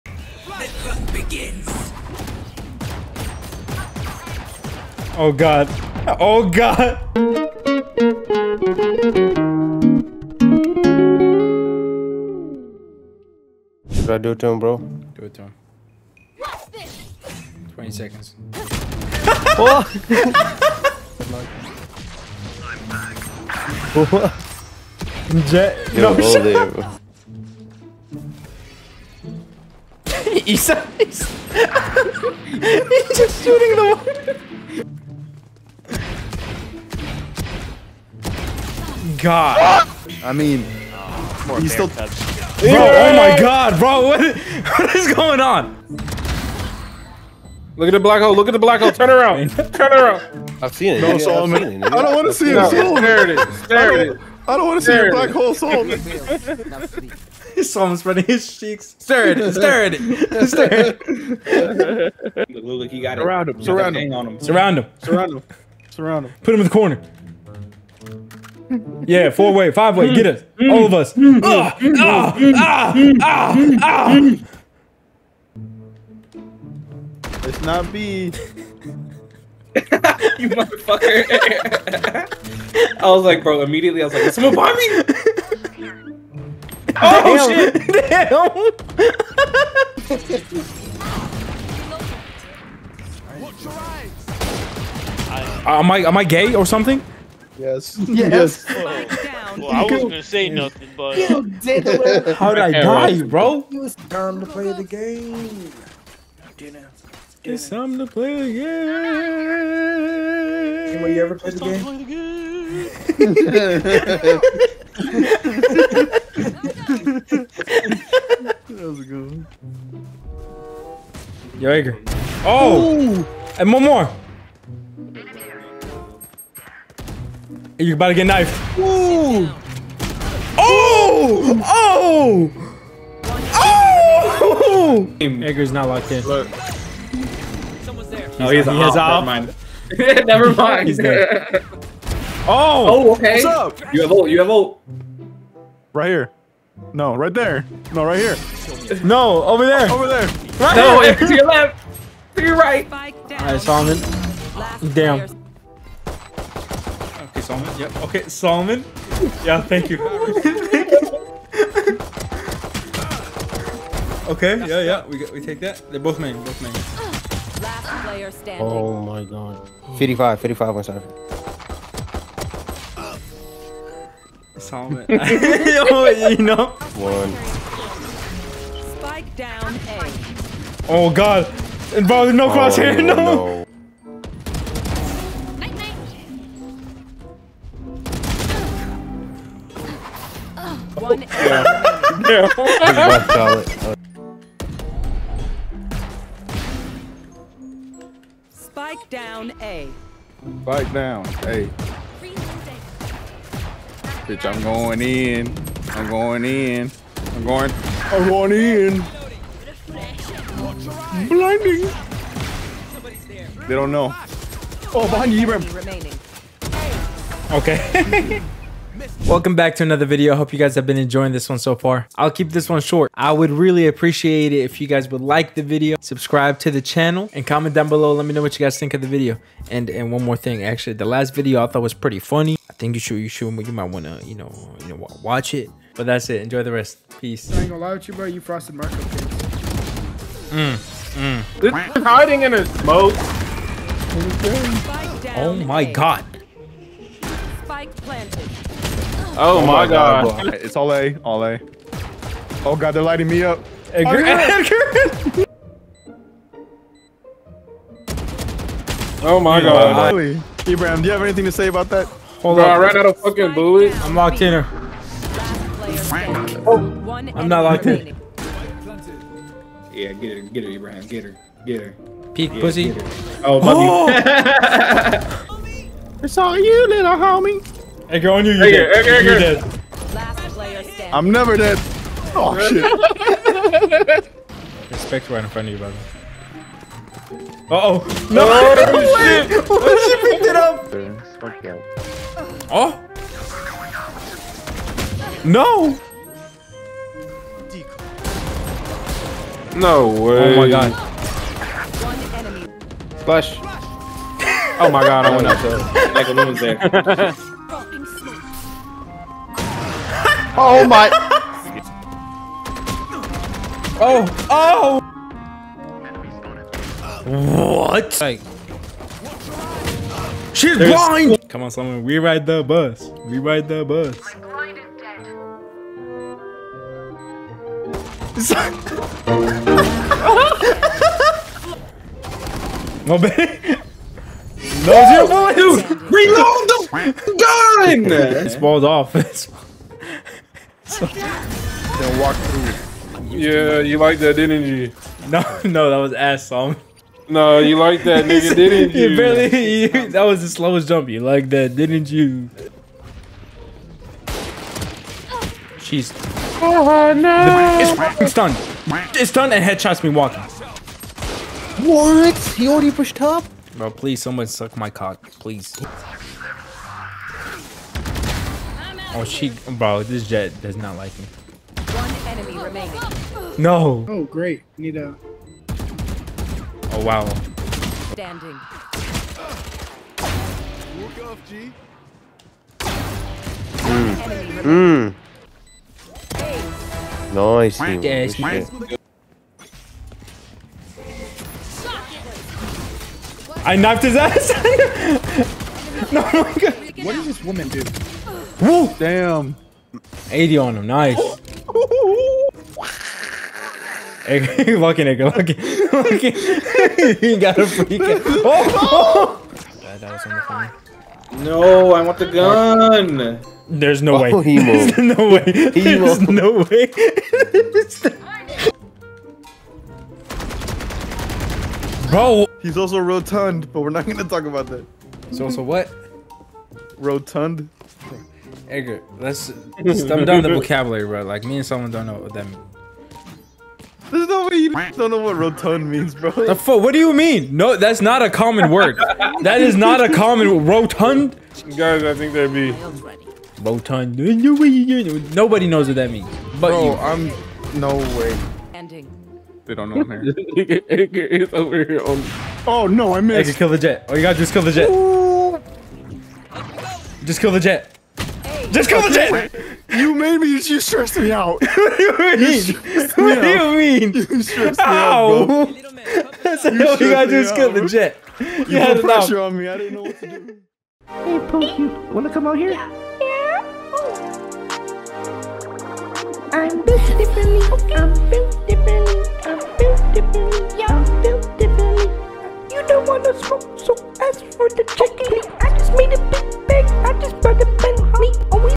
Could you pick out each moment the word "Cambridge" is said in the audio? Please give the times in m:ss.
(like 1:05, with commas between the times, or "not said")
not said.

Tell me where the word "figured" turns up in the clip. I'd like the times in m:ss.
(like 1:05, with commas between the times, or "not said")
not said.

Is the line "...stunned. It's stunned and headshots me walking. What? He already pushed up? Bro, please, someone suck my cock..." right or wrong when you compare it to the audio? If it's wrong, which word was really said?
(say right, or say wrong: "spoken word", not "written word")
right.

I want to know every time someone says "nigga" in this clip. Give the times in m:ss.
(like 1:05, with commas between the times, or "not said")
5:48, 6:45.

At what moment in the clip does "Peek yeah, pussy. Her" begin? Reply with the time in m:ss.
4:32.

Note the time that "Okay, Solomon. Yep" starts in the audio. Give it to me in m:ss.
2:37.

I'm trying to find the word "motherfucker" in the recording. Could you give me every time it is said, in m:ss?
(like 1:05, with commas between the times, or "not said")
1:20.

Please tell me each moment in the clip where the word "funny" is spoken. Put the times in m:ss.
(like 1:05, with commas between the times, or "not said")
3:52.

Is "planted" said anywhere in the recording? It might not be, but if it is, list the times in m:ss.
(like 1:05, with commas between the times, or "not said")
4:07.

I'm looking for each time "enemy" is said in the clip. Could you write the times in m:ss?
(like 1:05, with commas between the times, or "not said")
6:12.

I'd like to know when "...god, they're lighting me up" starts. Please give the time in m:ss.
4:12.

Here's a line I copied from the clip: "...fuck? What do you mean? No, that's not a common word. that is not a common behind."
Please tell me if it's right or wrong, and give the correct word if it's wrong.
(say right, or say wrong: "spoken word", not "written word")
wrong: "rotund", not "behind".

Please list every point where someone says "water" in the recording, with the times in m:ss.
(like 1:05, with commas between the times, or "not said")
0:33.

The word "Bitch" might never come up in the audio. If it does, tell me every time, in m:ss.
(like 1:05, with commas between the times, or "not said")
3:24.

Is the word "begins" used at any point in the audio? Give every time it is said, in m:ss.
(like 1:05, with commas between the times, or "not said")
0:01.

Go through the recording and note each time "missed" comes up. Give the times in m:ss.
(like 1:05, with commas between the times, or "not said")
7:33.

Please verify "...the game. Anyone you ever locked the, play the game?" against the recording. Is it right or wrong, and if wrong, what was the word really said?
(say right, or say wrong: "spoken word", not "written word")
wrong: "played", not "locked".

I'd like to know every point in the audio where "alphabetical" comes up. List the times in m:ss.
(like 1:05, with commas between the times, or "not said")
not said.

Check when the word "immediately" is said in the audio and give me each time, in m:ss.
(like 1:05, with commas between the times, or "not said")
1:23.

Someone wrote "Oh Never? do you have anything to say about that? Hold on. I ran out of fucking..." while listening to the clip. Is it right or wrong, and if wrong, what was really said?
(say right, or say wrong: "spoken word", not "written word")
wrong: "Ibrahim", not "Never".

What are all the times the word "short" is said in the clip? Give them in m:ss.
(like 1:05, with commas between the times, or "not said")
3:42.